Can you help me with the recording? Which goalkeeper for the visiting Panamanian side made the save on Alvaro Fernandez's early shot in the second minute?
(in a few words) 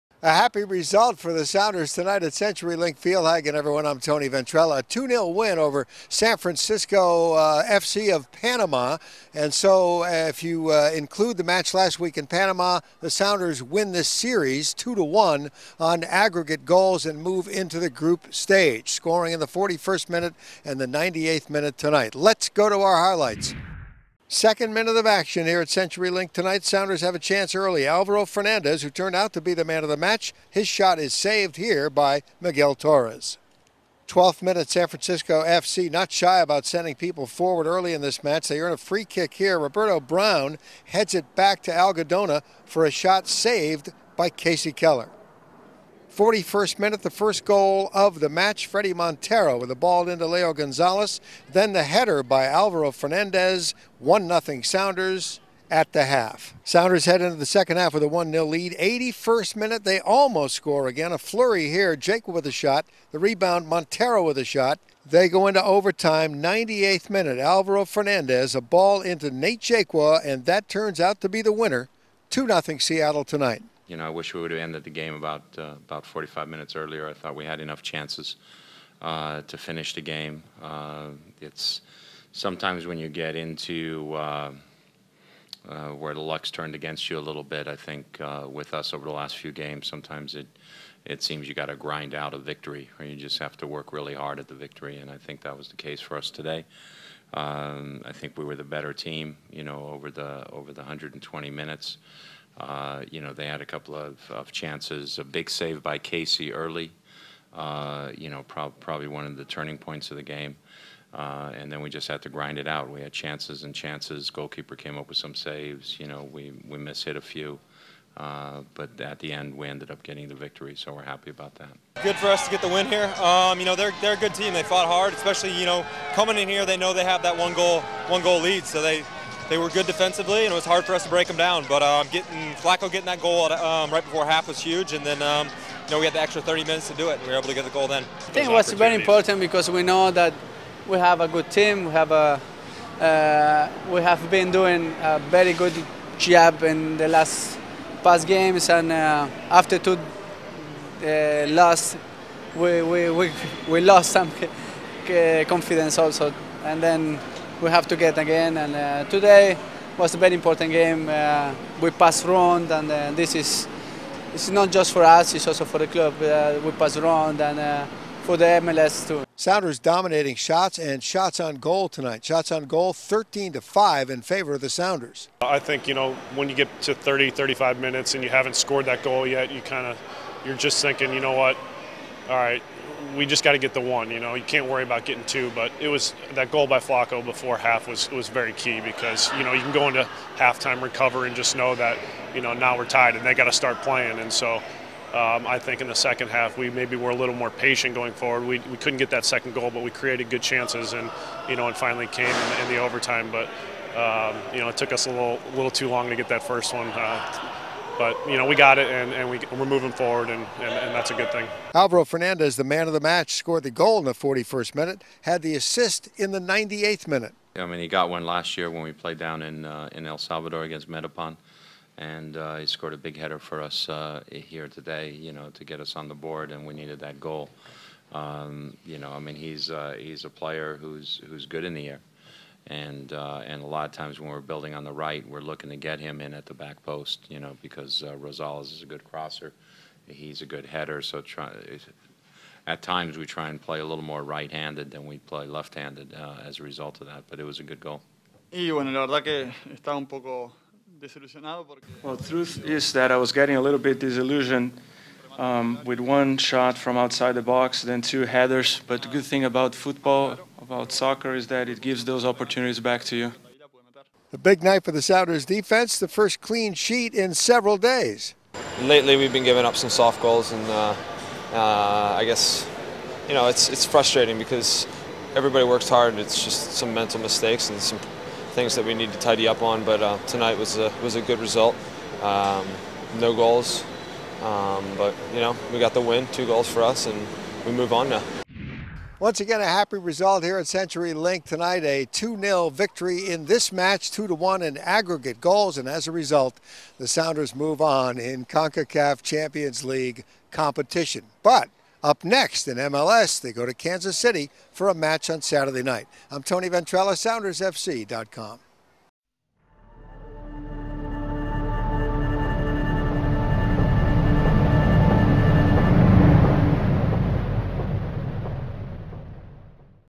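Miguel Torres.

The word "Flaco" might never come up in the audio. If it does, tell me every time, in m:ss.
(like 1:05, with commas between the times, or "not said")
2:12, 3:06.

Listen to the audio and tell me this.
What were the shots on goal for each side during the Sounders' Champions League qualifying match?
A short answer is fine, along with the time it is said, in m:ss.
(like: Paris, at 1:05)
13 to 5, at 2:52.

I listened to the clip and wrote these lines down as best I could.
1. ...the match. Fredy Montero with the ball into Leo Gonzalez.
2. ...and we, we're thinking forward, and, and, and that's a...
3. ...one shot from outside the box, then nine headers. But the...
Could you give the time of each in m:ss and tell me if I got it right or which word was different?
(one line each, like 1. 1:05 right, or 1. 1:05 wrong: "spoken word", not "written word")
1. 0:48 right
2. 3:29 wrong: "moving", not "thinking"
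3. 4:16 wrong: "two", not "nine".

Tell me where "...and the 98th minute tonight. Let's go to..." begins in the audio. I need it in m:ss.
0:20.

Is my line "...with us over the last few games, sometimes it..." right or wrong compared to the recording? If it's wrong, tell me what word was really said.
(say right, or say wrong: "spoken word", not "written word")
right.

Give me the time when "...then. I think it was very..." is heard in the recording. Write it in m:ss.
2:17.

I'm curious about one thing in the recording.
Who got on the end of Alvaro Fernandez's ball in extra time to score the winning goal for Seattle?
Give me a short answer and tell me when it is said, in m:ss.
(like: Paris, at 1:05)
Nate Jaqua, at 1:09.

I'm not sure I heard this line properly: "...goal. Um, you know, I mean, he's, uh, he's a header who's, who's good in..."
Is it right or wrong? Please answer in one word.
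wrong.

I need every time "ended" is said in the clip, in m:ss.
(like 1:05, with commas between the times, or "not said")
1:14, 1:59.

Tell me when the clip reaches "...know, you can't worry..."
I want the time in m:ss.
3:04.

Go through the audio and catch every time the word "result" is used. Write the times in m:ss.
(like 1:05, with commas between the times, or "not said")
0:00, 4:06, 4:41, 4:49, 4:56.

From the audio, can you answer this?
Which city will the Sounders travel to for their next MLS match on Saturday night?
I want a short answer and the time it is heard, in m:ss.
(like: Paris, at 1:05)
Kansas City, at 5:03.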